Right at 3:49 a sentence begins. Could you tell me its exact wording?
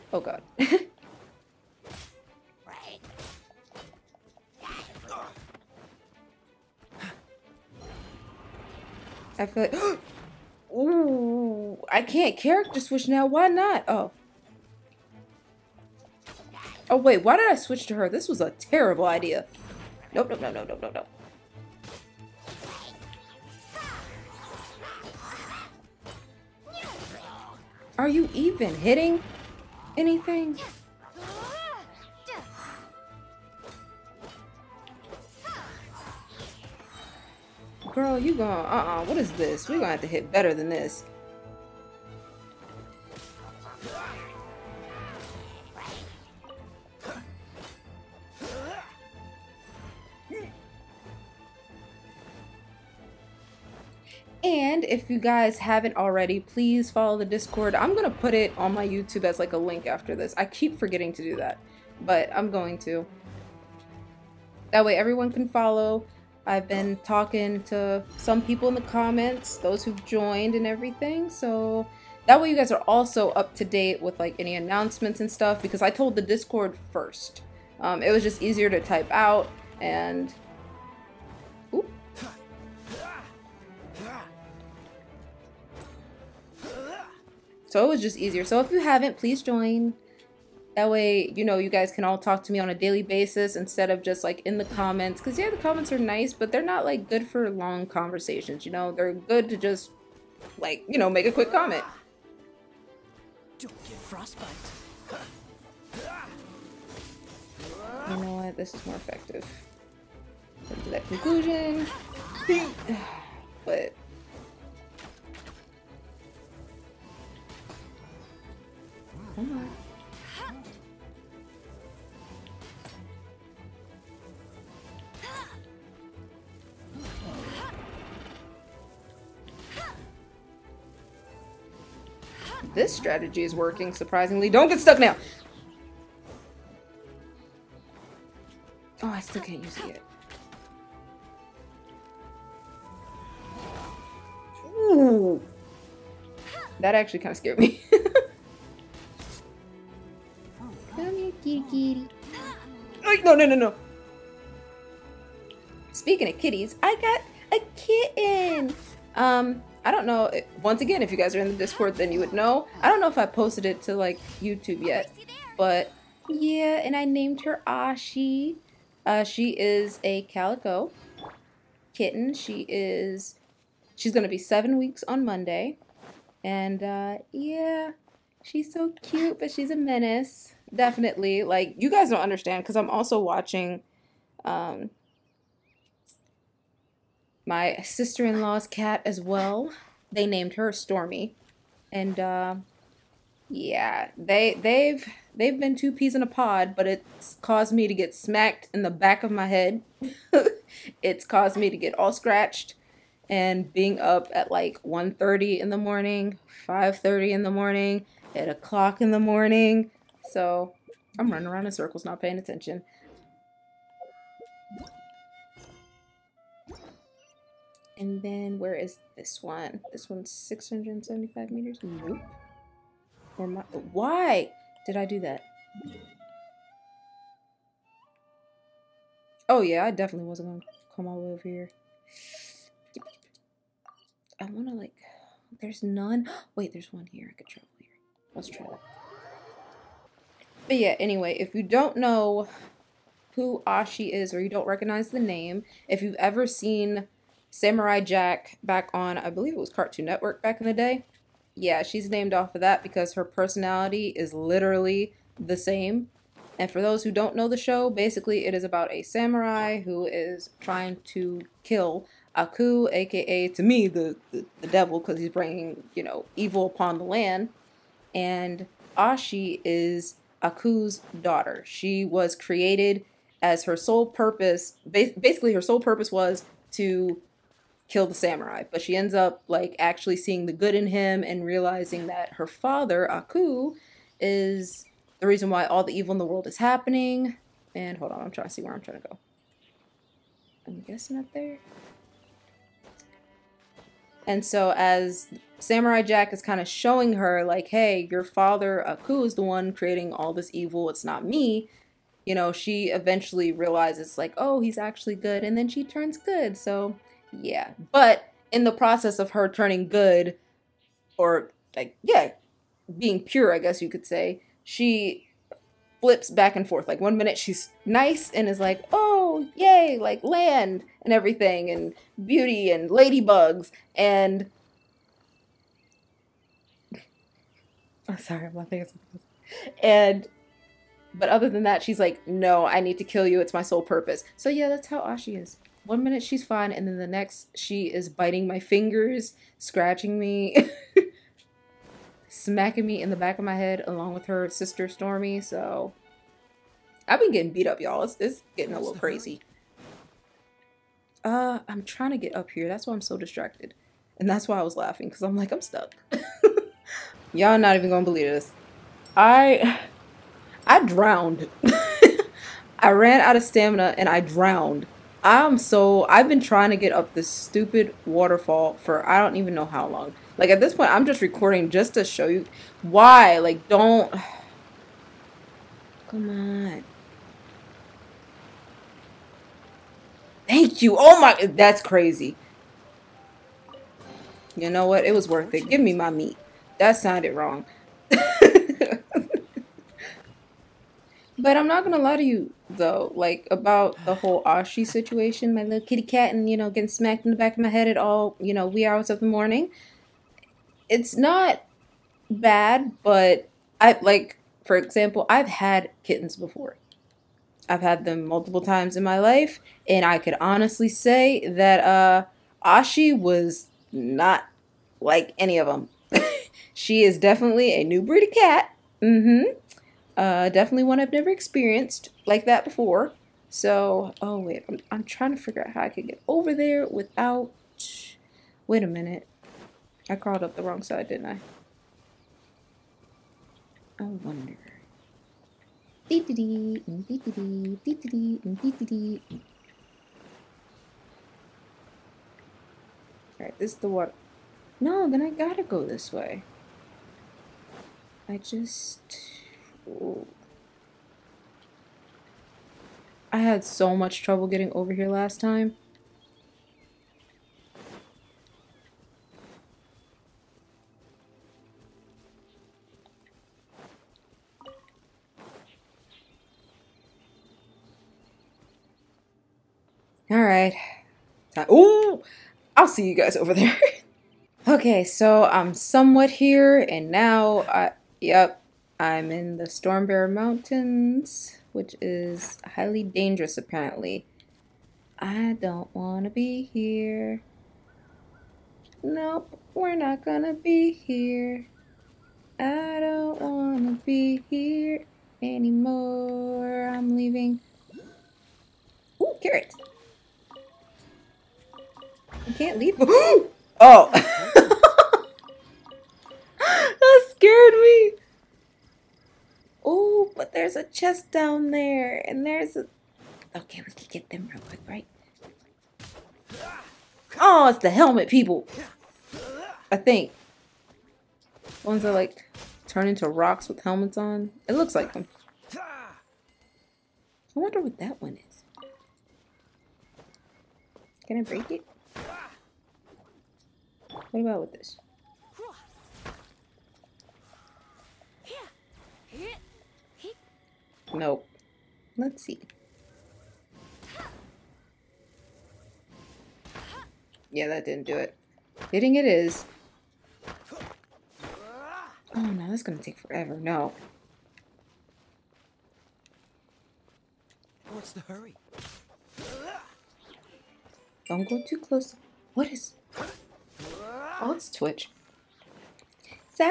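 Oh yeah, I definitely wasn't going to come all the way over here.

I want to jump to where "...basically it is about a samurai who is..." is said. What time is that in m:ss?
4:17.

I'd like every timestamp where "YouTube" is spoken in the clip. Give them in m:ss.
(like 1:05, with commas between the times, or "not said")
0:58, 2:44.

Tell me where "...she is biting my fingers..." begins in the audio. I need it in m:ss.
5:37.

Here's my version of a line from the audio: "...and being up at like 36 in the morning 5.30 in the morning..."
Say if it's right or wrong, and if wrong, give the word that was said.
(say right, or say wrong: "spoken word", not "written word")
wrong: "30", not "36".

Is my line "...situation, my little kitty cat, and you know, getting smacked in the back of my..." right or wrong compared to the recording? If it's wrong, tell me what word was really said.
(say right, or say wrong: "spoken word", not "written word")
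right.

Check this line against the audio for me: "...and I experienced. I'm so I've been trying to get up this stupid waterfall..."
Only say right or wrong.
wrong.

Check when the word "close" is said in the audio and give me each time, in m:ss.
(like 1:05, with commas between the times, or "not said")
9:21.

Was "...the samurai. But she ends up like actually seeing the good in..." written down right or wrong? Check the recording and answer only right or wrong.
right.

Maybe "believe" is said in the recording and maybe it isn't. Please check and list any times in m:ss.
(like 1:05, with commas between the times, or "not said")
4:09, 5:58.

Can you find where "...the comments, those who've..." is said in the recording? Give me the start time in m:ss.
1:08.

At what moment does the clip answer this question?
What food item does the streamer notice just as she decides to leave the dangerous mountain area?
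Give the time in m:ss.
8:19.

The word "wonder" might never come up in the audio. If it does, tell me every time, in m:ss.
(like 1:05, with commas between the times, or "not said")
7:14, 8:47.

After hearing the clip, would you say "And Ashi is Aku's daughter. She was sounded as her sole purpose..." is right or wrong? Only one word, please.
wrong.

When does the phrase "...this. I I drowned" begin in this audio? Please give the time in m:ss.
5:58.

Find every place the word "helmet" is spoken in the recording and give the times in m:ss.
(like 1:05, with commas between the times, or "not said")
8:37, 8:43.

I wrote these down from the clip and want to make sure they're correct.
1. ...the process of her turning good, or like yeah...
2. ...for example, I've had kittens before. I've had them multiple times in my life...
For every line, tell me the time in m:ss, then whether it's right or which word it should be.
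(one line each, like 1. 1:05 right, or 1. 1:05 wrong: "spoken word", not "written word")
1. 5:08 right
2. 6:44 right.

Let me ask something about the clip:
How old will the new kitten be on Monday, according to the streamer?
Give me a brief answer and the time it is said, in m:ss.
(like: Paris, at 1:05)
7 weeks, at 2:54.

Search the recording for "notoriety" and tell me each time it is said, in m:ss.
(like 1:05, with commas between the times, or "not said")
not said.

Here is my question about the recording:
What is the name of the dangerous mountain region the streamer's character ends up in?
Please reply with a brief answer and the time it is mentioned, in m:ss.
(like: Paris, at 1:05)
Stormbear Mountains, at 7:59.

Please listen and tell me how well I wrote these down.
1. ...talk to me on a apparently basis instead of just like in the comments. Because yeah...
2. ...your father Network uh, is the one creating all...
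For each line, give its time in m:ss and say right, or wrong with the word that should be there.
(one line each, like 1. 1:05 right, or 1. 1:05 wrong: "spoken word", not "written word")
1. 1:32 wrong: "daily", not "apparently"
2. 4:58 wrong: "Aku", not "Network".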